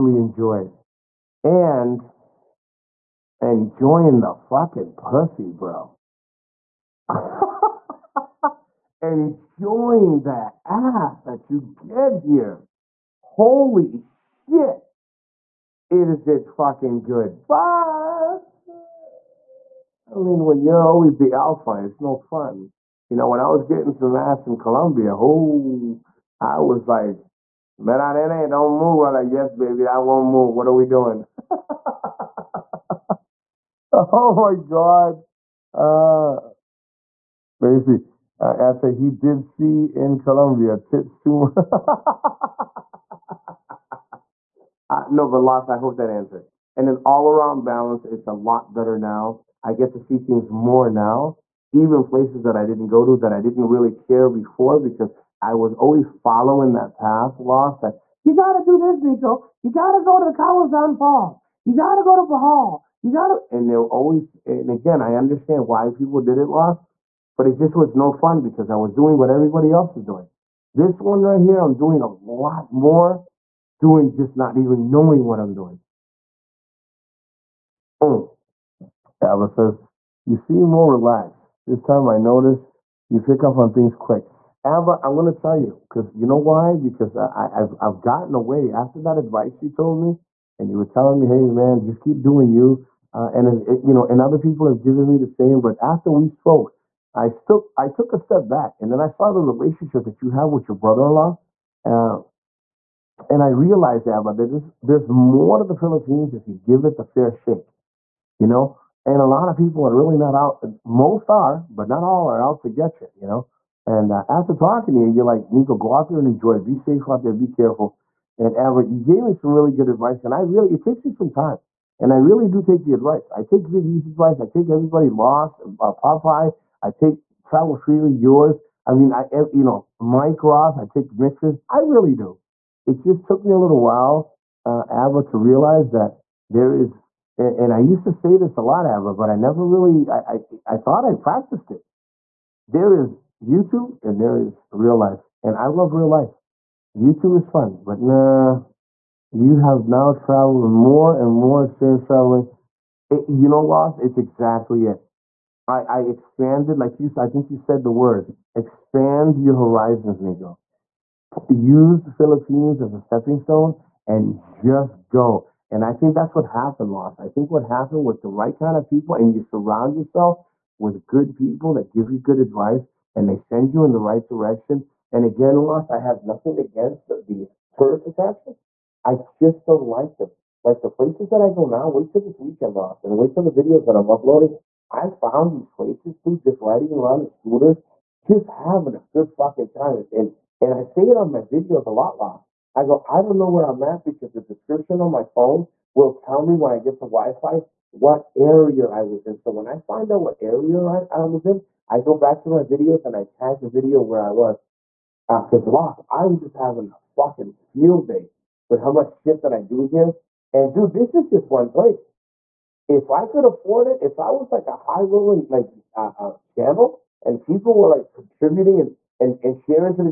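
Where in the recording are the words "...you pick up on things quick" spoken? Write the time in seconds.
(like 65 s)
83 s.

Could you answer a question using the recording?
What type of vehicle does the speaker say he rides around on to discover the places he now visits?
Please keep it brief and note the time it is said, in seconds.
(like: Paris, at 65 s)
Scooters, at 187 s.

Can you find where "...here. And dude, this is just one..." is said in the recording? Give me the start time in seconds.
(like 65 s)
209 s.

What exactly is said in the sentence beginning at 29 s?
I'm like, yes, baby, I won't move.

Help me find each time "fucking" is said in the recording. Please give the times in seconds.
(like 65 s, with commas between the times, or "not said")
4 s, 16 s, 189 s, 207 s.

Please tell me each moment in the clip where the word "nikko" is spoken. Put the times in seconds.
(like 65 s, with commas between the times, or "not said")
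58 s, 115 s, 160 s.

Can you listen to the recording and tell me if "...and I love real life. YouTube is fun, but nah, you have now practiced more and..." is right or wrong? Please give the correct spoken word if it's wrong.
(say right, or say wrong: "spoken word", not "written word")
wrong: "traveled", not "practiced".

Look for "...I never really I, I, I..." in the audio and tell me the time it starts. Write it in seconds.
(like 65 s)
139 s.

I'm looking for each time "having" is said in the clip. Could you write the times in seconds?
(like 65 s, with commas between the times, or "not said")
188 s, 206 s.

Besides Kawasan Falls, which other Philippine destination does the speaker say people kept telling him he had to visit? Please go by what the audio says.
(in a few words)
Bohol.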